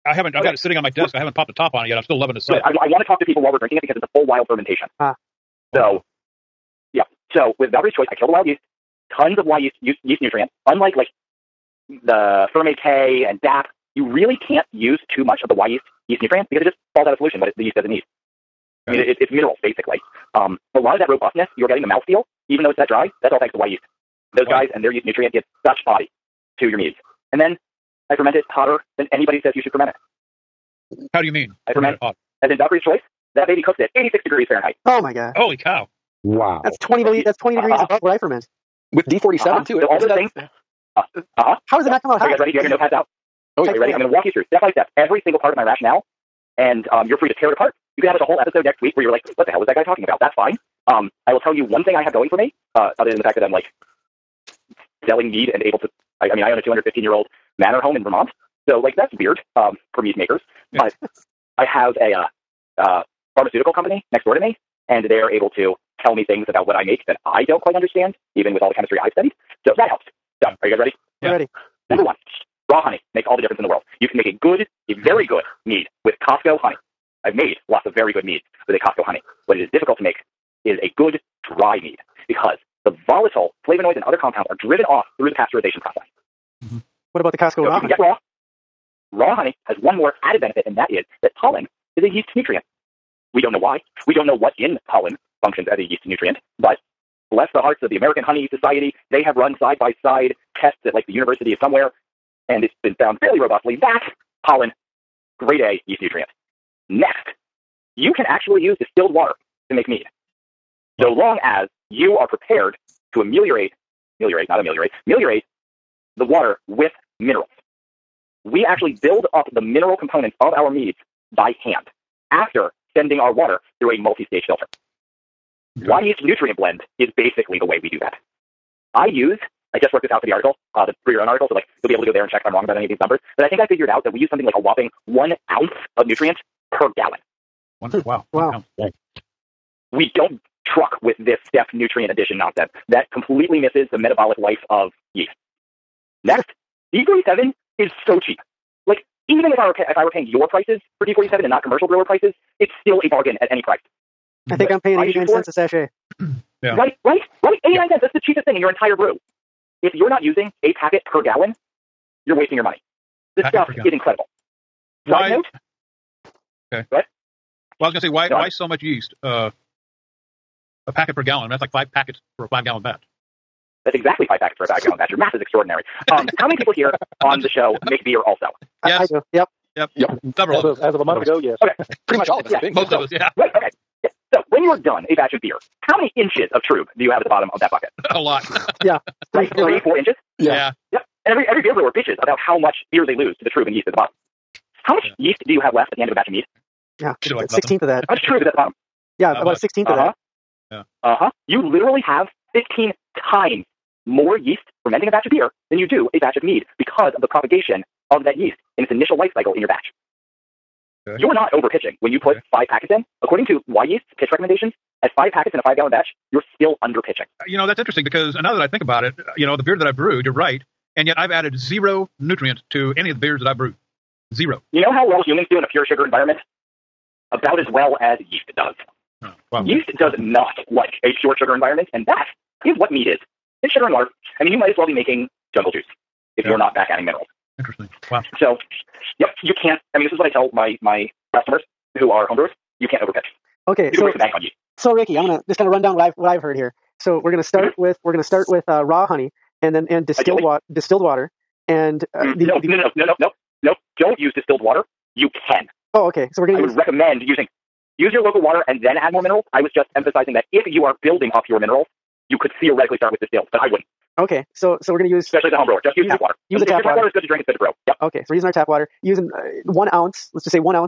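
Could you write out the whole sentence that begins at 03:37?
You know, that's interesting because now that I think about it, uh, you know, the beer that I brewed, you're right.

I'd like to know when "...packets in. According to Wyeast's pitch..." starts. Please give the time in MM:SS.
03:32.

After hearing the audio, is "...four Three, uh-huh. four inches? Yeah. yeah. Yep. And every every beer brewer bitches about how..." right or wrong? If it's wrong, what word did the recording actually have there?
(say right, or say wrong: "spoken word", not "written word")
right.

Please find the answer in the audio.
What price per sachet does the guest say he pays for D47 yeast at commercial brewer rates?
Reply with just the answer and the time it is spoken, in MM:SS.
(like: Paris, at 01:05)
89 cents, at 02:34.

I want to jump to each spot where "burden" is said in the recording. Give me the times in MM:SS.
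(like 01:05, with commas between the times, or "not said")
not said.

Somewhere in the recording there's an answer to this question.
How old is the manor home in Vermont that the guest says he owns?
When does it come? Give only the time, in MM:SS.
00:56.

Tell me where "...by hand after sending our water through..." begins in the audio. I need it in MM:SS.
02:01.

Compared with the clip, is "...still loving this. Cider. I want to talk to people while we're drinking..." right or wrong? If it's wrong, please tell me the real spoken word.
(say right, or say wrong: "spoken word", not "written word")
right.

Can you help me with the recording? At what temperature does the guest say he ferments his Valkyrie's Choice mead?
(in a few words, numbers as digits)
86 degrees Fahrenheit.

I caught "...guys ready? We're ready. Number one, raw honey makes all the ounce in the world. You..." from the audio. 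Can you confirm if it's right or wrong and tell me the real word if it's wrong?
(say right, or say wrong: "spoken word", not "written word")
wrong: "difference", not "ounce".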